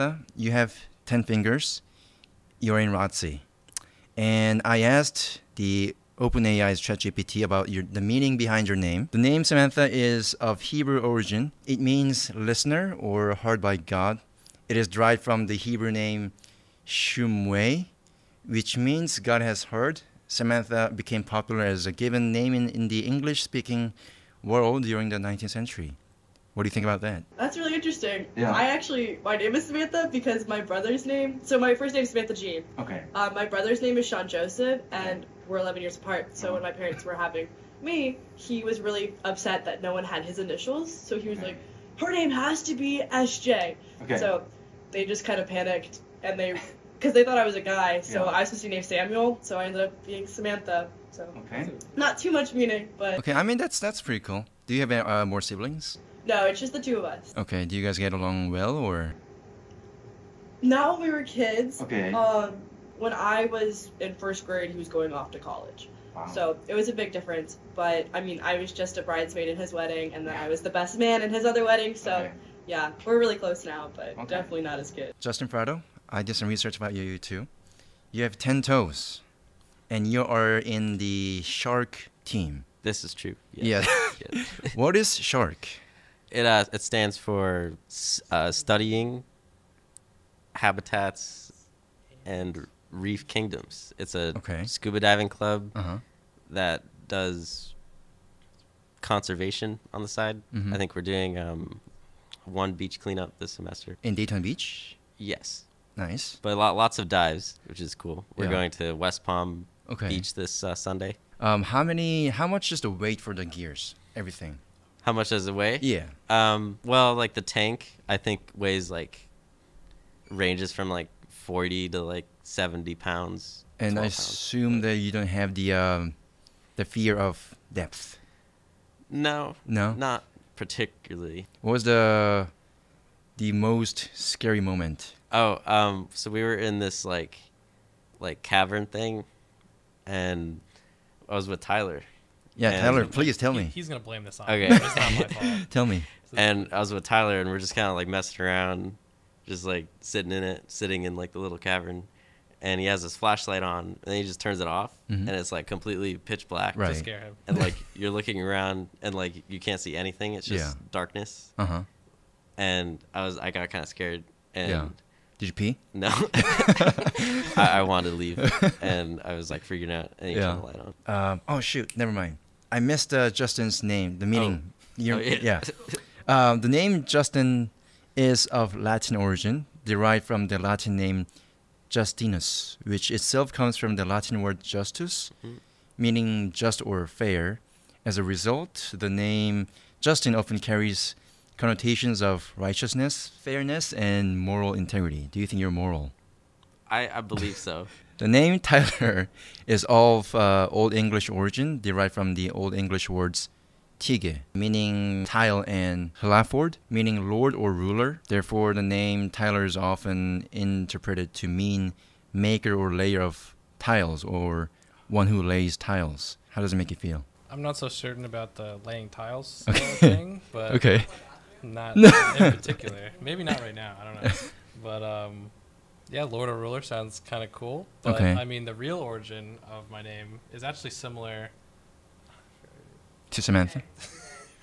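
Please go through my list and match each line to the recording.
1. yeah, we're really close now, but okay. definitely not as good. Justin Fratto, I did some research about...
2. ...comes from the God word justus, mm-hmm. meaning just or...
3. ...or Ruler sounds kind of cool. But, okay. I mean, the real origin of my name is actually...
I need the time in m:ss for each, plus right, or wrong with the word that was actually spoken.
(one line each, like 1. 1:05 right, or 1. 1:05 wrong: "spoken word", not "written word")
1. 1:12 right
2. 3:03 wrong: "Latin", not "God"
3. 3:46 right.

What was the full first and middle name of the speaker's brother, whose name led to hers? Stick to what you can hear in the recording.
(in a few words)
Sean Joseph.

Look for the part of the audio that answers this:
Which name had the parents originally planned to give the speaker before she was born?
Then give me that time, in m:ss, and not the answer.
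0:48.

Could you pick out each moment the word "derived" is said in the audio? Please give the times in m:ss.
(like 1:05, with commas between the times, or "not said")
0:14, 2:59, 3:21.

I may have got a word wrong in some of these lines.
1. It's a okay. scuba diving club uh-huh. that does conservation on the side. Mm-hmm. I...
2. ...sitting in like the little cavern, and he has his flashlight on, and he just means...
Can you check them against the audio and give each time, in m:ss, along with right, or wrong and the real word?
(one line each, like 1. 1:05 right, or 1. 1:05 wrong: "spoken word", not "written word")
1. 1:33 right
2. 2:30 wrong: "turns", not "means".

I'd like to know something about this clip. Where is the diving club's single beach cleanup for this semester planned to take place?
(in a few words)
Daytona Beach.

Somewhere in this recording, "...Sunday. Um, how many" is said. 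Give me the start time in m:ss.
1:50.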